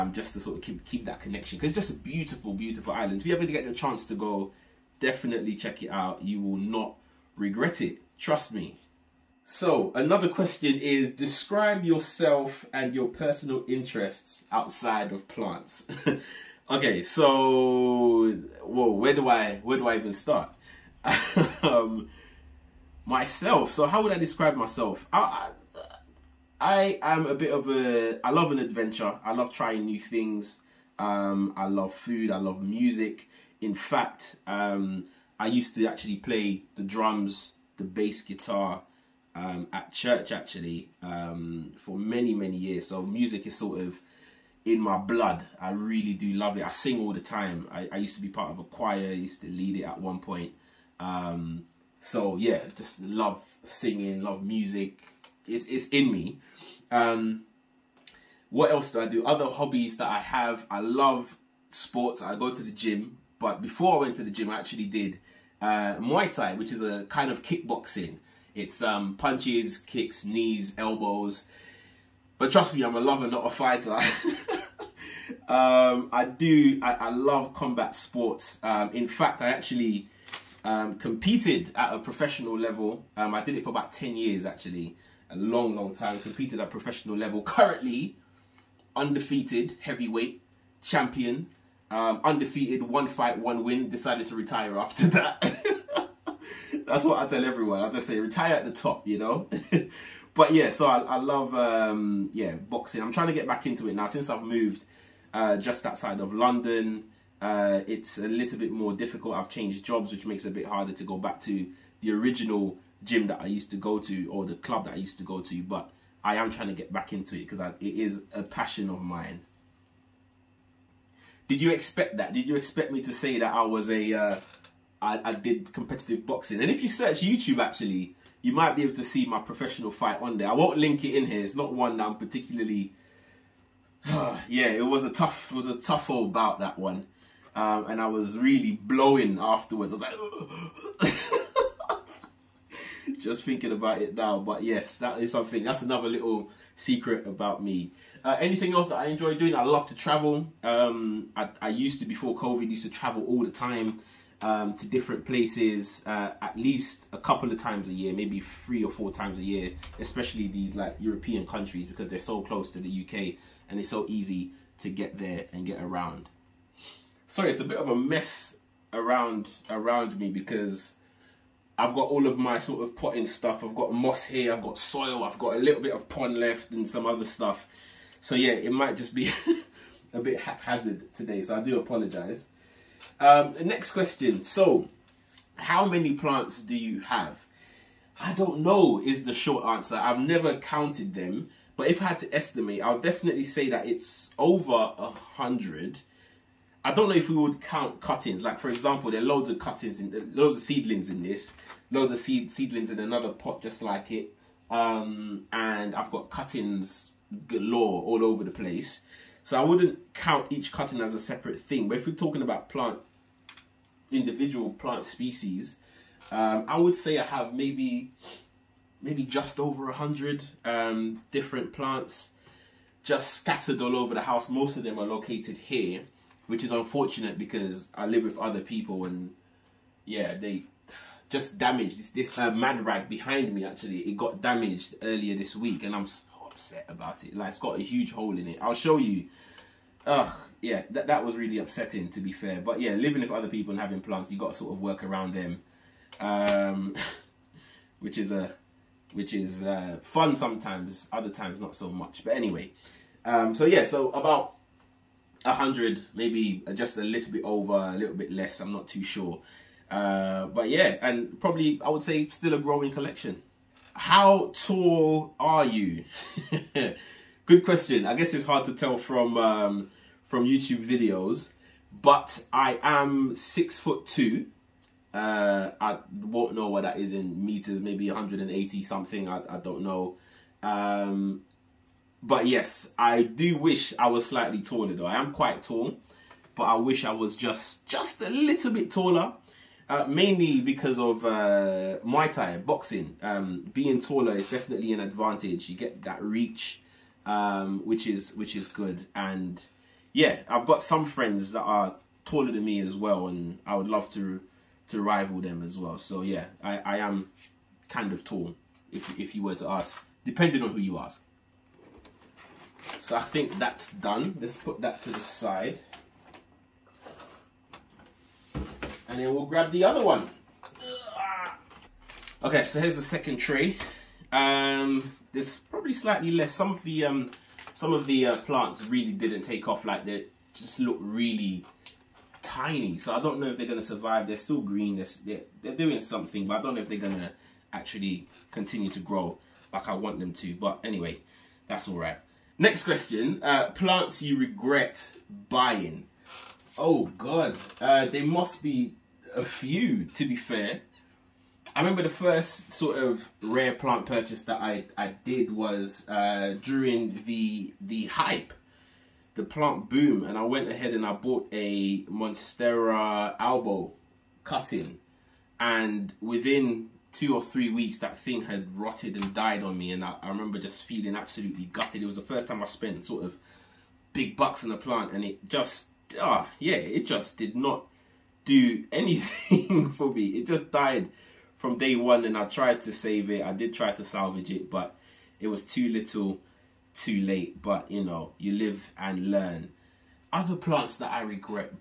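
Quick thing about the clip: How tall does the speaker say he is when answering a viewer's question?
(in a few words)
6 foot 2.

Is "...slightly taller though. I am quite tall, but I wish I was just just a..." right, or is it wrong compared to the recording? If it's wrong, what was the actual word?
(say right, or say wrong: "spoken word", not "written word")
right.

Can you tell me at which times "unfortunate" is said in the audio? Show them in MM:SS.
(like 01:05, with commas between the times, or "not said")
03:46.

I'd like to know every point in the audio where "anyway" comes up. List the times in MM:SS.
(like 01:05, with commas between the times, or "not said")
04:12, 05:40.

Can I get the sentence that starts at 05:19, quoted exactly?
and then we'll grab the other one.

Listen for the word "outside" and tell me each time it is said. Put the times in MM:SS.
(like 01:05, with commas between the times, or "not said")
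00:14, 01:45.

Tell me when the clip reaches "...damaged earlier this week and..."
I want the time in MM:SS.
03:54.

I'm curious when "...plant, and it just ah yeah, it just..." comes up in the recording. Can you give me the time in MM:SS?
06:14.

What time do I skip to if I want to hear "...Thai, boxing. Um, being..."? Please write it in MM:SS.
04:52.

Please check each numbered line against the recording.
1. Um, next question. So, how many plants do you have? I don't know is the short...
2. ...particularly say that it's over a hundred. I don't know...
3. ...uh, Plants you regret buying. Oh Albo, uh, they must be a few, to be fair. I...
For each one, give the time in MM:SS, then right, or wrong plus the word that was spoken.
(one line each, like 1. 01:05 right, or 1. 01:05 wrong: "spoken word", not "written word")
1. 03:03 right
2. 03:12 wrong: "definitely", not "particularly"
3. 05:43 wrong: "God", not "Albo".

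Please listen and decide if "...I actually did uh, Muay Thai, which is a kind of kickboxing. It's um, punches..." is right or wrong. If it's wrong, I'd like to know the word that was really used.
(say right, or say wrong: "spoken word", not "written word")
right.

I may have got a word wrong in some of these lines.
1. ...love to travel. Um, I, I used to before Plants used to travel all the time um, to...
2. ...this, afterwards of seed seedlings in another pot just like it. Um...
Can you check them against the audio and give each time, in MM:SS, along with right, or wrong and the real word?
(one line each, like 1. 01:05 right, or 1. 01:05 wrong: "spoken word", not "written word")
1. 02:29 wrong: "COVID", not "Plants"
2. 03:21 wrong: "loads", not "afterwards".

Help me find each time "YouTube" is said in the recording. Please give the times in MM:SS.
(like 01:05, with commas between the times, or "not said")
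02:07, 04:30.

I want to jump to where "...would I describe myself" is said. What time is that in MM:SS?
00:24.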